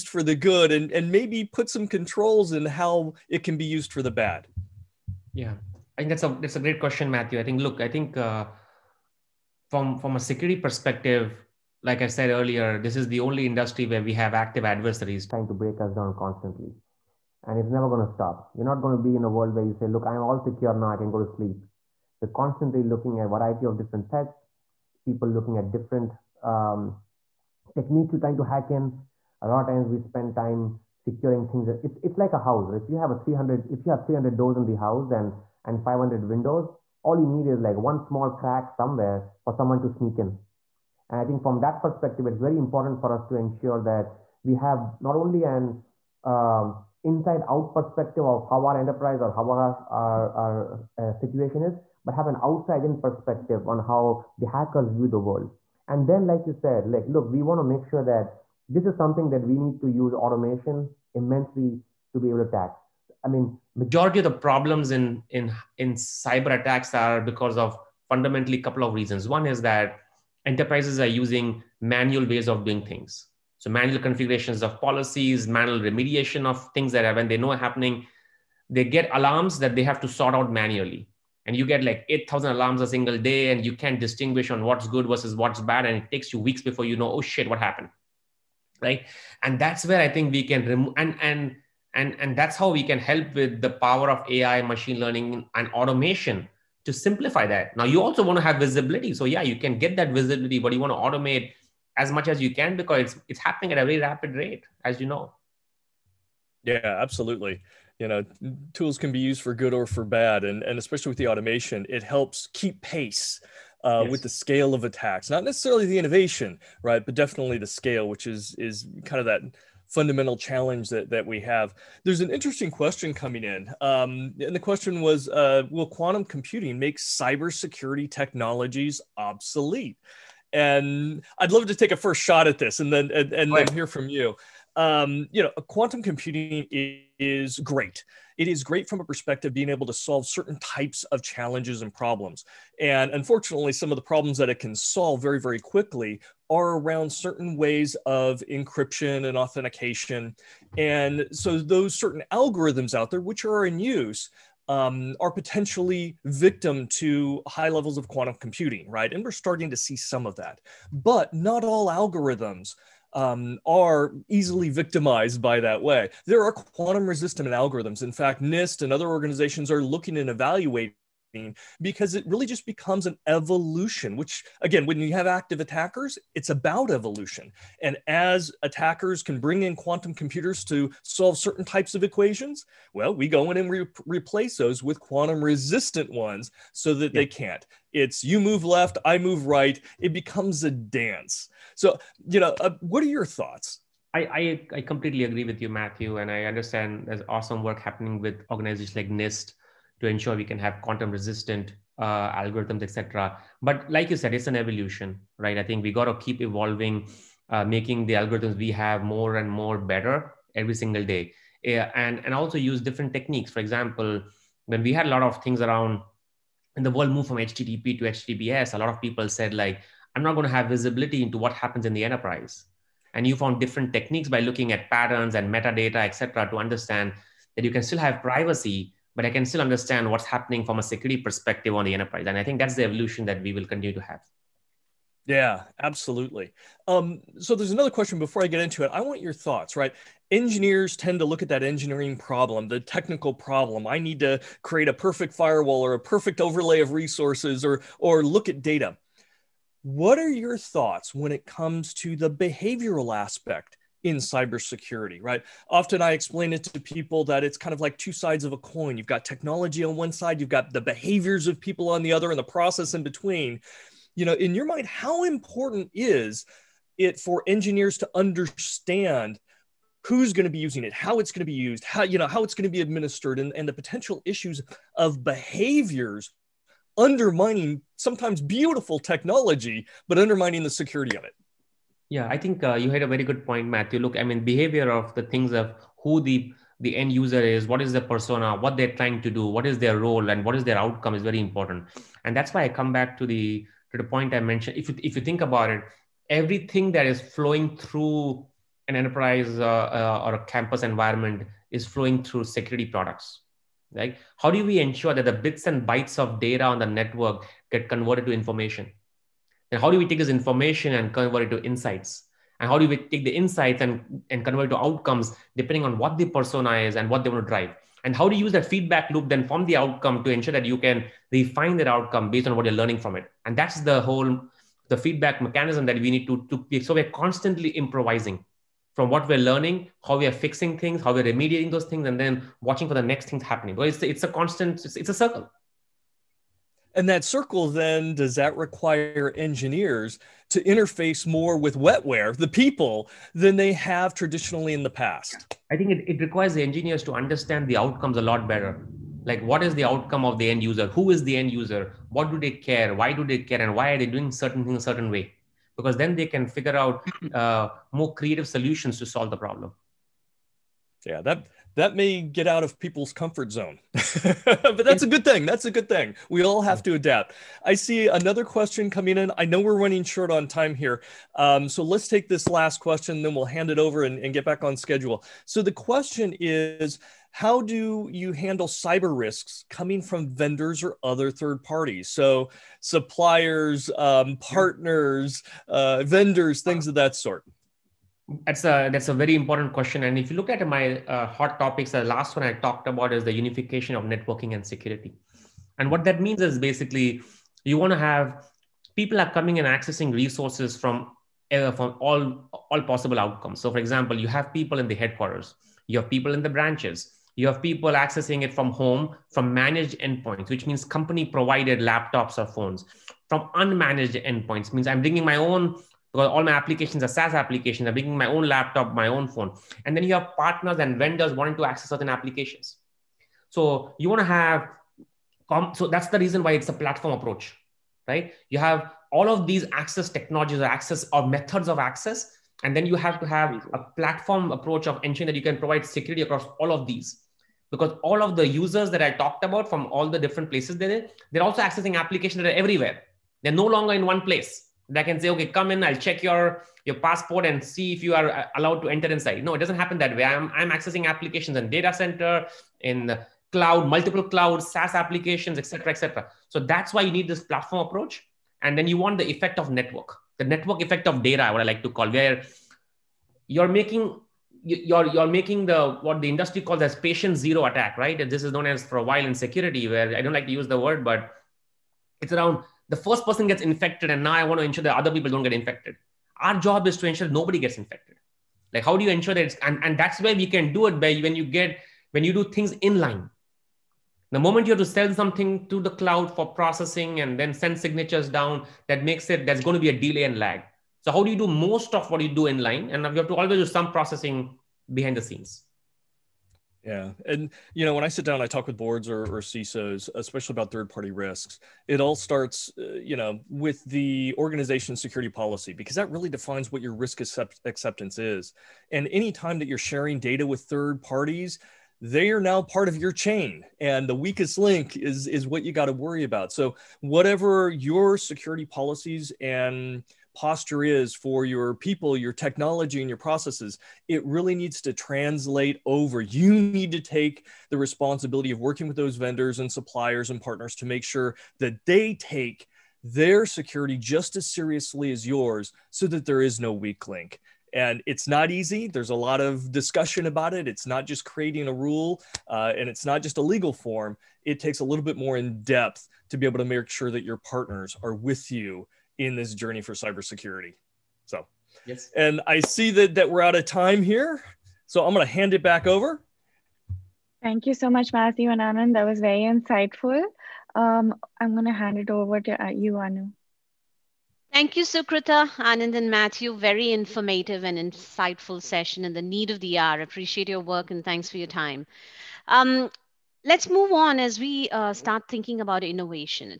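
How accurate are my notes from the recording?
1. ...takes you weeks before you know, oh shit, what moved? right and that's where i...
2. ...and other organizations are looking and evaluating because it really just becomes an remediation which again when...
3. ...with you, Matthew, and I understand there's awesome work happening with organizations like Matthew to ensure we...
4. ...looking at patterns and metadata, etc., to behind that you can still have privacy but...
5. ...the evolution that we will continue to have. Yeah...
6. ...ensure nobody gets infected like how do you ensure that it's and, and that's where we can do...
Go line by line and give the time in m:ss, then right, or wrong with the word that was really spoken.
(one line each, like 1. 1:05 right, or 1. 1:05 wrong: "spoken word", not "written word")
1. 1:26 wrong: "happened", not "moved"
2. 2:48 wrong: "evolution", not "remediation"
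3. 3:15 wrong: "NIST", not "Matthew"
4. 3:44 wrong: "understand", not "behind"
5. 3:52 right
6. 7:57 right.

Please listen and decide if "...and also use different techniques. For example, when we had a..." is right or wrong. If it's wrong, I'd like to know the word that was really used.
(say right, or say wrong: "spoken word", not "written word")
right.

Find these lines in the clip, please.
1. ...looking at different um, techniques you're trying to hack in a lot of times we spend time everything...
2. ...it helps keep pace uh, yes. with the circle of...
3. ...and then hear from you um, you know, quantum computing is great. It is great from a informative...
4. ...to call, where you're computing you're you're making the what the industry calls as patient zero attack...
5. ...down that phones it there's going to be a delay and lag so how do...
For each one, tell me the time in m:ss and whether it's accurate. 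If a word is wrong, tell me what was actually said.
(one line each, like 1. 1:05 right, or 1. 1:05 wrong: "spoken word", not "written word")
1. 0:25 wrong: "securing", not "everything"
2. 1:51 wrong: "scale", not "circle"
3. 2:13 wrong: "perspective", not "informative"
4. 7:41 wrong: "making", not "computing"
5. 8:08 wrong: "makes", not "phones".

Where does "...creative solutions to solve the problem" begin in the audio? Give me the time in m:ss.
5:58.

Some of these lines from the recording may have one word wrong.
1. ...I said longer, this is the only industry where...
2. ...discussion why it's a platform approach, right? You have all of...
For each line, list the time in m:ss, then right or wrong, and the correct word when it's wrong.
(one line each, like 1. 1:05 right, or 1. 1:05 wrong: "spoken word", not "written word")
1. 0:12 wrong: "earlier", not "longer"
2. 7:06 wrong: "reason", not "discussion".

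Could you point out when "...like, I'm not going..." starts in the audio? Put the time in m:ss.
3:39.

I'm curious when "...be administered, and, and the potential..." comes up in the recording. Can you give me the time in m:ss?
4:32.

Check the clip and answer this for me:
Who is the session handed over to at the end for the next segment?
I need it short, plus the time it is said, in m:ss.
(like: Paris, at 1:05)
Anu, at 9:22.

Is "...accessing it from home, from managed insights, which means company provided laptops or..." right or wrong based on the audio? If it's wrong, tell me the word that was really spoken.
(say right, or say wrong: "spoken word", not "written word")
wrong: "endpoints", not "insights".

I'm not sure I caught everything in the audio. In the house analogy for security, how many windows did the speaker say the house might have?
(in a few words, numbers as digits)
500.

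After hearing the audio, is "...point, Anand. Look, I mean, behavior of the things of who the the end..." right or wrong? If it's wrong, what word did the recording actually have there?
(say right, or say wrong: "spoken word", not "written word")
wrong: "Matthew", not "Anand".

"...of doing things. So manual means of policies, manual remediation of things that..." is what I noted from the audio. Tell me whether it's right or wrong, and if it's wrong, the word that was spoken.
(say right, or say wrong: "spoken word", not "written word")
wrong: "configurations", not "means".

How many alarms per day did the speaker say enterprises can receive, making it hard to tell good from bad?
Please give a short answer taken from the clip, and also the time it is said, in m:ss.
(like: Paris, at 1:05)
8,000, at 1:22.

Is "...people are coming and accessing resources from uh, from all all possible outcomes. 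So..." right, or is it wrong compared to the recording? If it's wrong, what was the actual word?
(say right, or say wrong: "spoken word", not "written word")
right.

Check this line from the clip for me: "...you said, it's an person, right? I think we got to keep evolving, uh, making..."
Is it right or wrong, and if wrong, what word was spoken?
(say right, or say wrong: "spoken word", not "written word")
wrong: "evolution", not "person".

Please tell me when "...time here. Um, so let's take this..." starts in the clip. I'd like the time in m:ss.
6:10.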